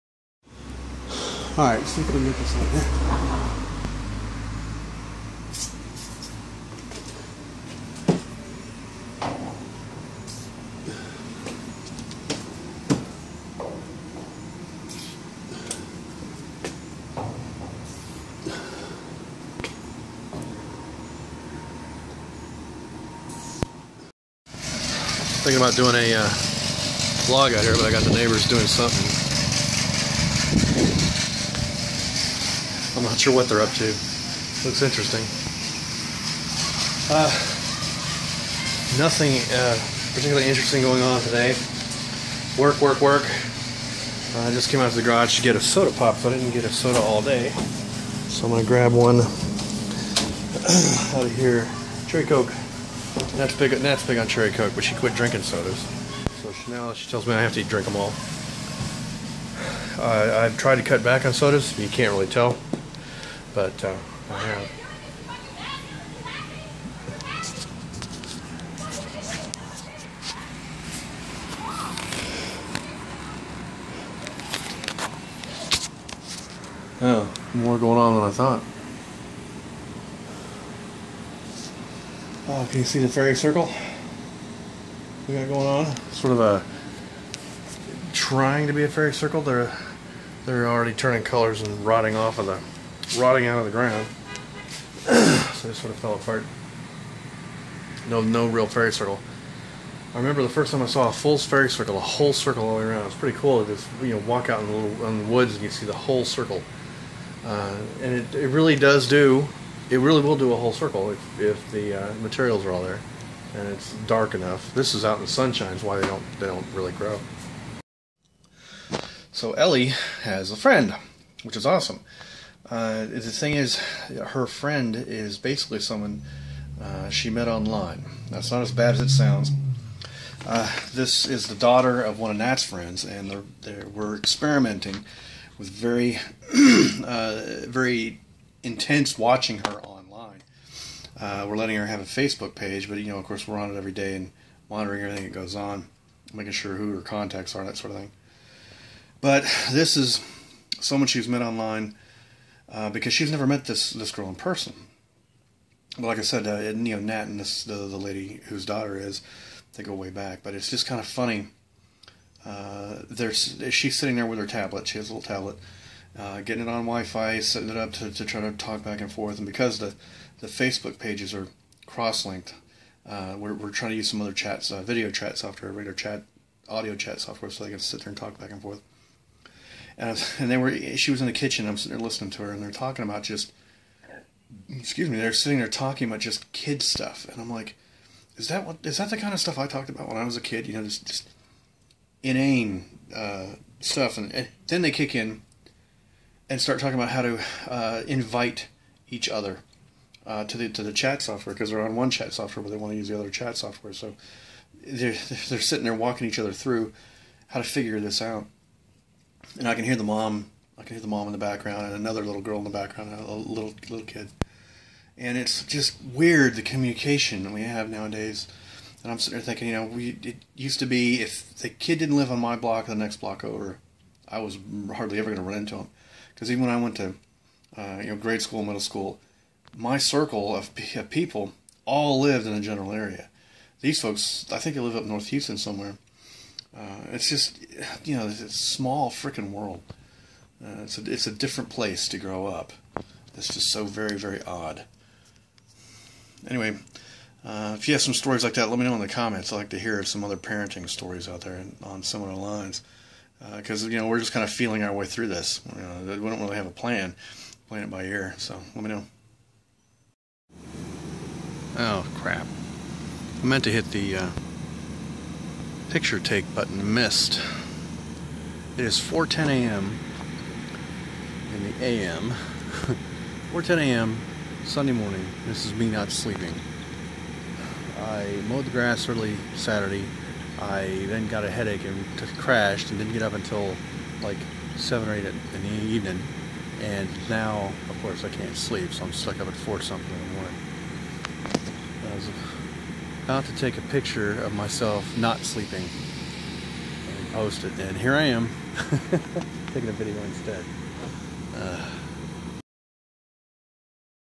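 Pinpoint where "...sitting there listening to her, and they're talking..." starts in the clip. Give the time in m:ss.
3:01.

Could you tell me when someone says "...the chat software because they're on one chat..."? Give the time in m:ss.
3:20.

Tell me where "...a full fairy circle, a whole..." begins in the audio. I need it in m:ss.
1:41.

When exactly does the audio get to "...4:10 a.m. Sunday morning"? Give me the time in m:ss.
4:33.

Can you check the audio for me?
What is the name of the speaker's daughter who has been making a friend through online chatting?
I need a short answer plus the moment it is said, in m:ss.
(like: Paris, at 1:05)
Ellie, at 1:59.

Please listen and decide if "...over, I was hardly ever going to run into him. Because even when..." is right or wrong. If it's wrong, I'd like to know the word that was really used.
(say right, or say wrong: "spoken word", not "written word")
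right.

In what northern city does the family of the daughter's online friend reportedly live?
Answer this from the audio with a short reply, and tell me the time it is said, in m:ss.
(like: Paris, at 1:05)
Houston, at 3:55.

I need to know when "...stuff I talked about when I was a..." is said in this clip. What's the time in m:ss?
3:09.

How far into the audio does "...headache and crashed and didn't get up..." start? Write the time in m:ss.
4:41.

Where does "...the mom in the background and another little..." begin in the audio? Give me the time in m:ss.
3:31.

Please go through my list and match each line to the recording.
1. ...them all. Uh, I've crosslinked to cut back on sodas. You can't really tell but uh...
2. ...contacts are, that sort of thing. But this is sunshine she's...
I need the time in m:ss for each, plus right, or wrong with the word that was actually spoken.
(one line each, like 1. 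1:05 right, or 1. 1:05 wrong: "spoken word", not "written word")
1. 0:57 wrong: "tried", not "crosslinked"
2. 2:27 wrong: "someone", not "sunshine".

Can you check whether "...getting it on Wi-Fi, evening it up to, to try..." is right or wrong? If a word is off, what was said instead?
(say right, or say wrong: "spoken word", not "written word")
wrong: "setting", not "evening".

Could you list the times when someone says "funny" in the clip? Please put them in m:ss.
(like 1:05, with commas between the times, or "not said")
2:41.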